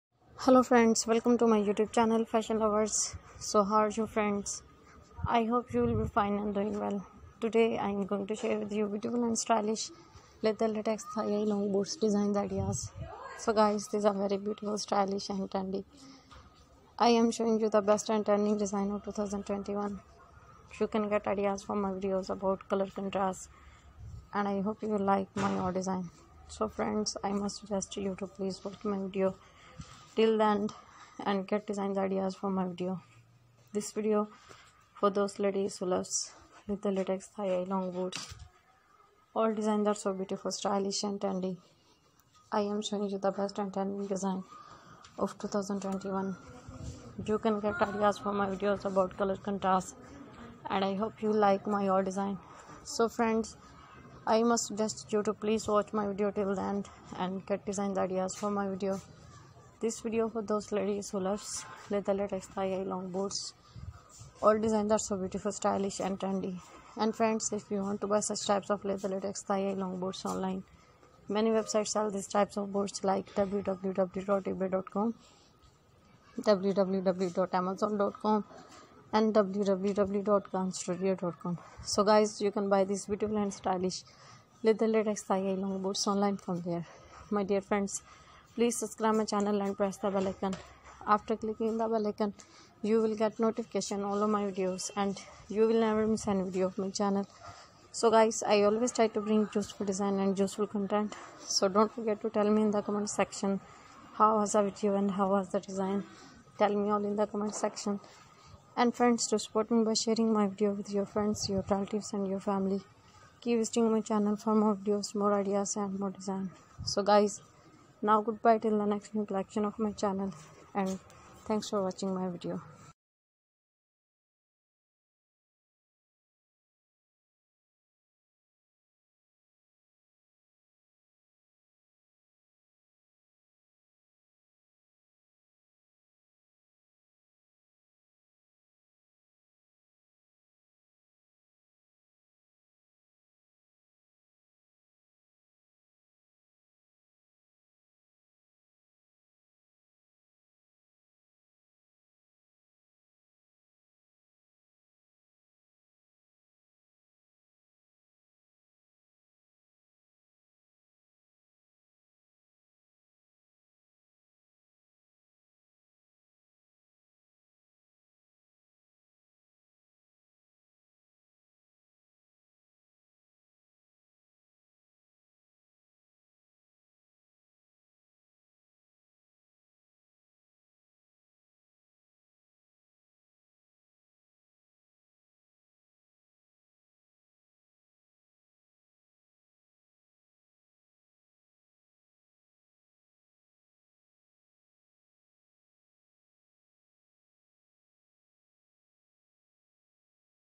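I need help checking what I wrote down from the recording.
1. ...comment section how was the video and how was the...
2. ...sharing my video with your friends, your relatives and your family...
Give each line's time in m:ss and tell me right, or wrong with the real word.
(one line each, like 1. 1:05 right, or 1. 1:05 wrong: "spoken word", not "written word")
1. 1:42 right
2. 1:49 right.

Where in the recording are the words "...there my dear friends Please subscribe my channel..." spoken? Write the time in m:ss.
1:26.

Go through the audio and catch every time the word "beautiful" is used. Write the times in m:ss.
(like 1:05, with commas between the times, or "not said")
0:08, 0:14, 0:40, 1:05, 1:23.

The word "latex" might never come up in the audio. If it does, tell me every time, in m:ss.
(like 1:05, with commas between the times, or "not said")
0:10, 0:36, 1:24.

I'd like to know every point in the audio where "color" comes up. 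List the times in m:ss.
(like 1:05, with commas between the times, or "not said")
0:22, 0:49.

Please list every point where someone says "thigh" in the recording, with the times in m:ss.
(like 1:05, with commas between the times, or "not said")
0:11, 0:37, 1:25.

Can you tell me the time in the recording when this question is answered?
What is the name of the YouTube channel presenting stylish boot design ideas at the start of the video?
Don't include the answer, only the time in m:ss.
0:02.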